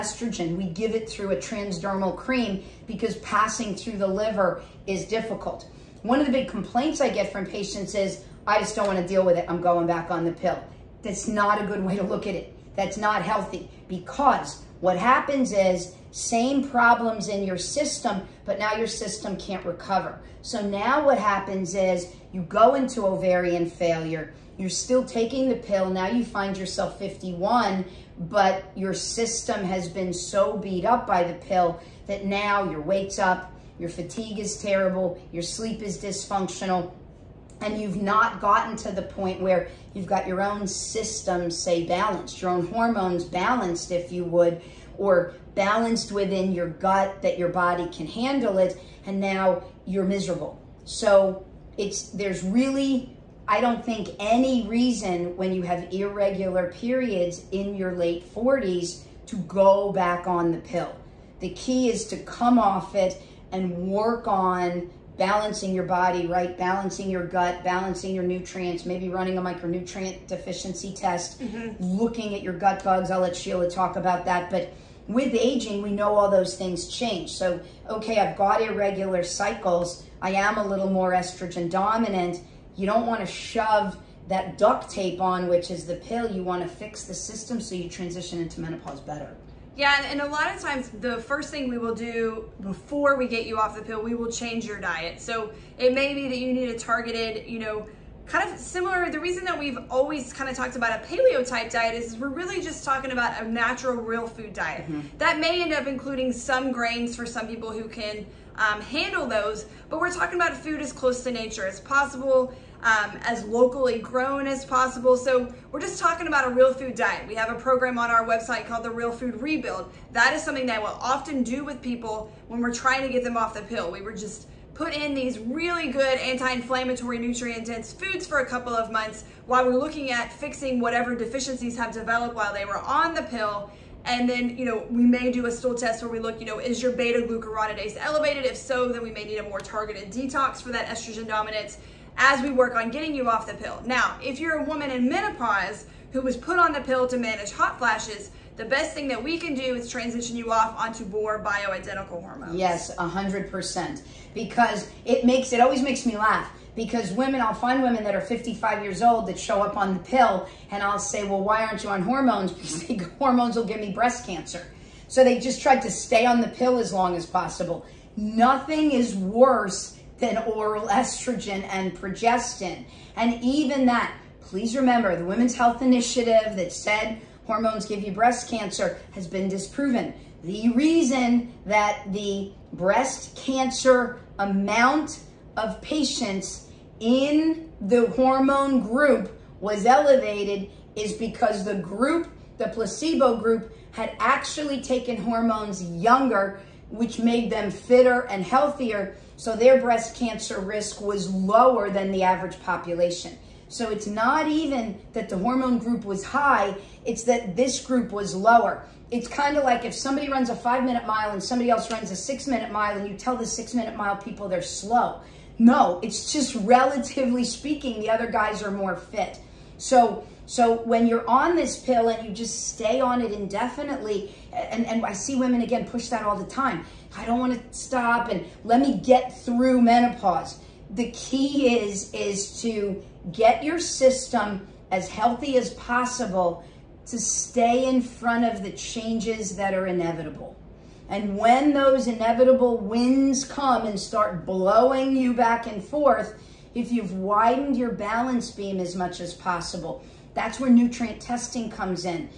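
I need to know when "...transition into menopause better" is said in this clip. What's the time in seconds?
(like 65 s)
87 s.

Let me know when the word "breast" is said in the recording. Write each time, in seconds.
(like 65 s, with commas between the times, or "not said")
163 s, 178 s, 182 s, 199 s.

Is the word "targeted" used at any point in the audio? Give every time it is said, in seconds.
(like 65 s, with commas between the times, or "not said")
96 s, 139 s.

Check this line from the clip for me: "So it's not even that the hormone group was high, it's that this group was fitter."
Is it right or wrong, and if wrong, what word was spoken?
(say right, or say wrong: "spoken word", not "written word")
wrong: "lower", not "fitter".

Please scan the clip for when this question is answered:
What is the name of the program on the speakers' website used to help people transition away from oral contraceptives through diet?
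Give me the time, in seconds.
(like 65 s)
119 s.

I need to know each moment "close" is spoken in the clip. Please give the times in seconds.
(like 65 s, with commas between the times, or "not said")
111 s.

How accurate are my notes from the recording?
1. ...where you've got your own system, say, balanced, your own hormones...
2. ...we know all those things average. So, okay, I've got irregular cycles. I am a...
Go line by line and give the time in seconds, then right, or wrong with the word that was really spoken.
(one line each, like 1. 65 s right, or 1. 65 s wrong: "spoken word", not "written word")
1. 39 s right
2. 75 s wrong: "change", not "average".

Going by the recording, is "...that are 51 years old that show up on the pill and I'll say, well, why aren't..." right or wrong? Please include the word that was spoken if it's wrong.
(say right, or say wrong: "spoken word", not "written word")
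wrong: "55", not "51".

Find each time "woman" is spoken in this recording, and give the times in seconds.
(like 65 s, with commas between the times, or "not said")
144 s.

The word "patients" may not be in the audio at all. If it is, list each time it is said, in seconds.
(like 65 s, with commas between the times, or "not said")
7 s, 185 s.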